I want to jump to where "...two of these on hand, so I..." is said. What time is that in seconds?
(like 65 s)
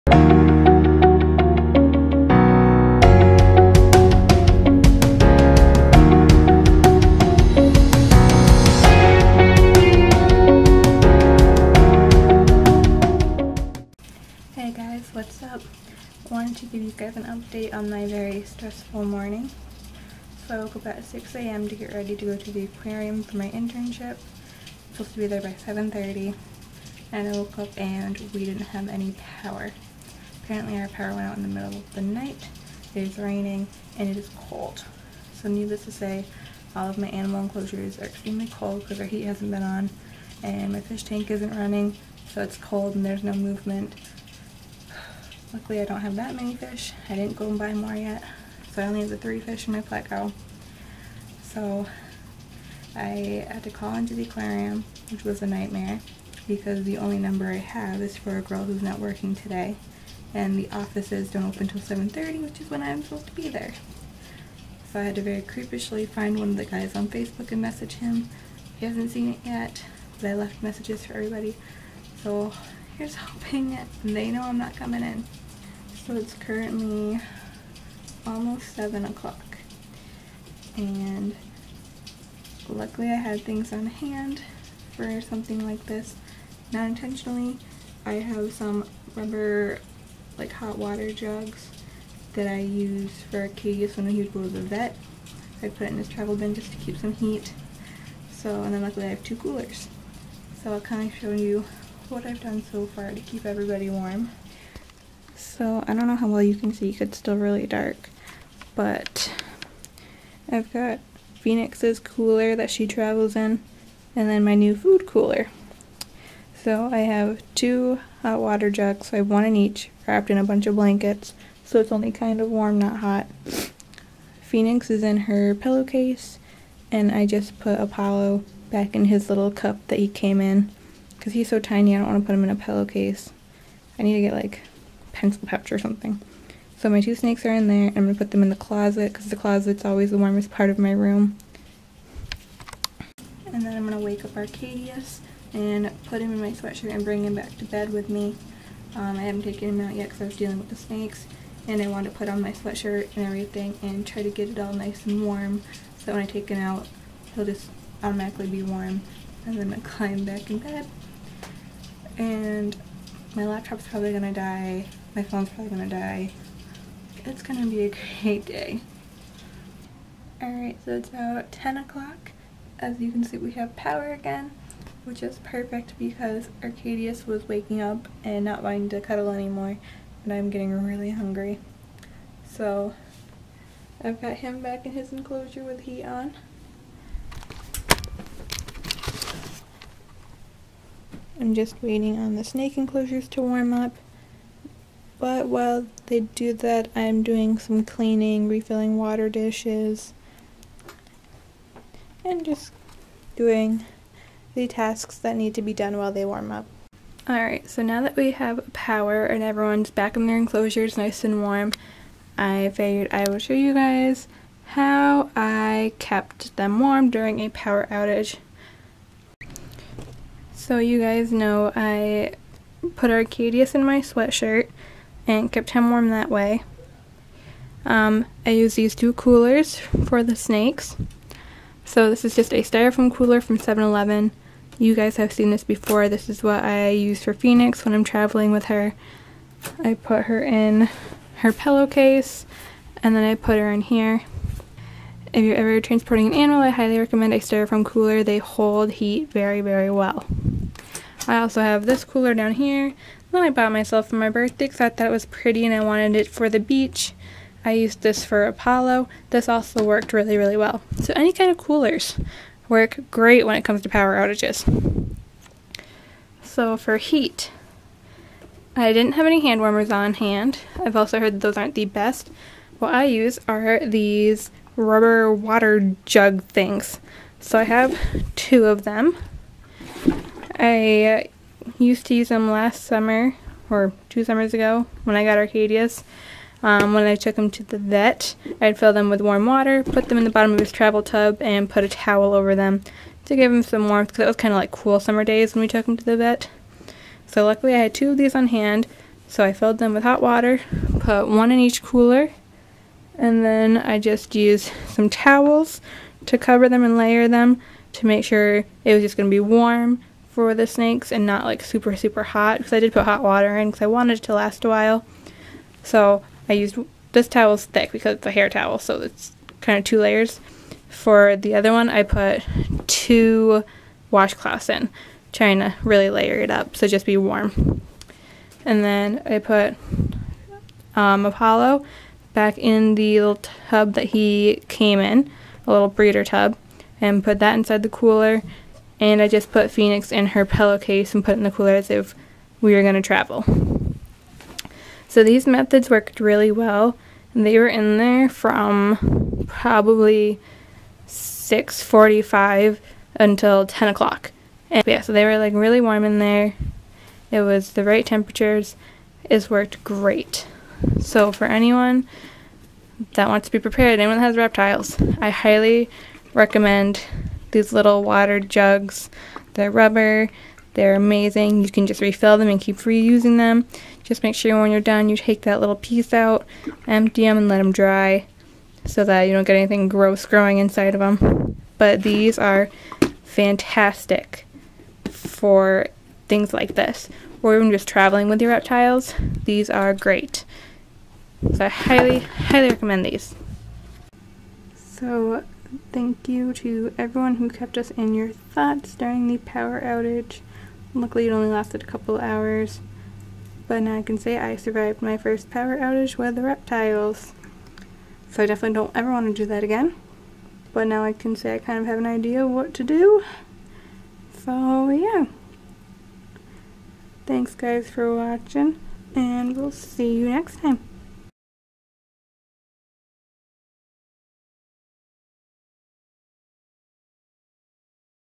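297 s.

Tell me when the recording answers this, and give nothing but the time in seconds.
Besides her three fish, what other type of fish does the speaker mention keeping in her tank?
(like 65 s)
49 s.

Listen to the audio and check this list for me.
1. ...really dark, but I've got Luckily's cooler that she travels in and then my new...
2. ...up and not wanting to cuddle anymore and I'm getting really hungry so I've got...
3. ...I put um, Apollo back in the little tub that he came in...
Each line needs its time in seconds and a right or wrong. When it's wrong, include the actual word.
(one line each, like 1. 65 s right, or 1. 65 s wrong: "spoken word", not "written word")
1. 107 s wrong: "Phoenix", not "Luckily"
2. 177 s right
3. 329 s right.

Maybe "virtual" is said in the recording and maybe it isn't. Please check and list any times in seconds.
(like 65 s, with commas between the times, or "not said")
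not said.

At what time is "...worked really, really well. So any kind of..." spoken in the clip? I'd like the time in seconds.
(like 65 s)
259 s.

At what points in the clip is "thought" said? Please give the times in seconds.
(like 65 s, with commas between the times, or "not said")
254 s, 398 s.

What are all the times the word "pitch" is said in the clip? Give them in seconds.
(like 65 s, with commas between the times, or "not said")
not said.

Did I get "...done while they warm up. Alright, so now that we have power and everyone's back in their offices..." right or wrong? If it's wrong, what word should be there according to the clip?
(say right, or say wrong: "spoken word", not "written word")
wrong: "enclosures", not "offices".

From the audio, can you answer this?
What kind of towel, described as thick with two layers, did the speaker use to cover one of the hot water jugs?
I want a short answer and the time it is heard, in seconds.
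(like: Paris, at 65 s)
hair towel, at 318 s.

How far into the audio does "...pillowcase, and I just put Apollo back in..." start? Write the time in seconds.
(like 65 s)
125 s.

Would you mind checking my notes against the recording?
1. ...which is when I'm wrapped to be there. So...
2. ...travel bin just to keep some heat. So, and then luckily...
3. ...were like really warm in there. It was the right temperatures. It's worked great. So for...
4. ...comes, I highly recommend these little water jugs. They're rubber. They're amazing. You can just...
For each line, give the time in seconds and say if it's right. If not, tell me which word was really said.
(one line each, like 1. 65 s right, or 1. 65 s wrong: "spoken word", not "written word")
1. 62 s wrong: "supposed", not "wrapped"
2. 96 s right
3. 355 s right
4. 364 s wrong: "reptiles", not "comes".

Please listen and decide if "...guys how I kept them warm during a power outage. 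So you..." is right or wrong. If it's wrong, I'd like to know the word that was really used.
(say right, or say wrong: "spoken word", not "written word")
right.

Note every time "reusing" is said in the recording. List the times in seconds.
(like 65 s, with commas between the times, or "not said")
372 s.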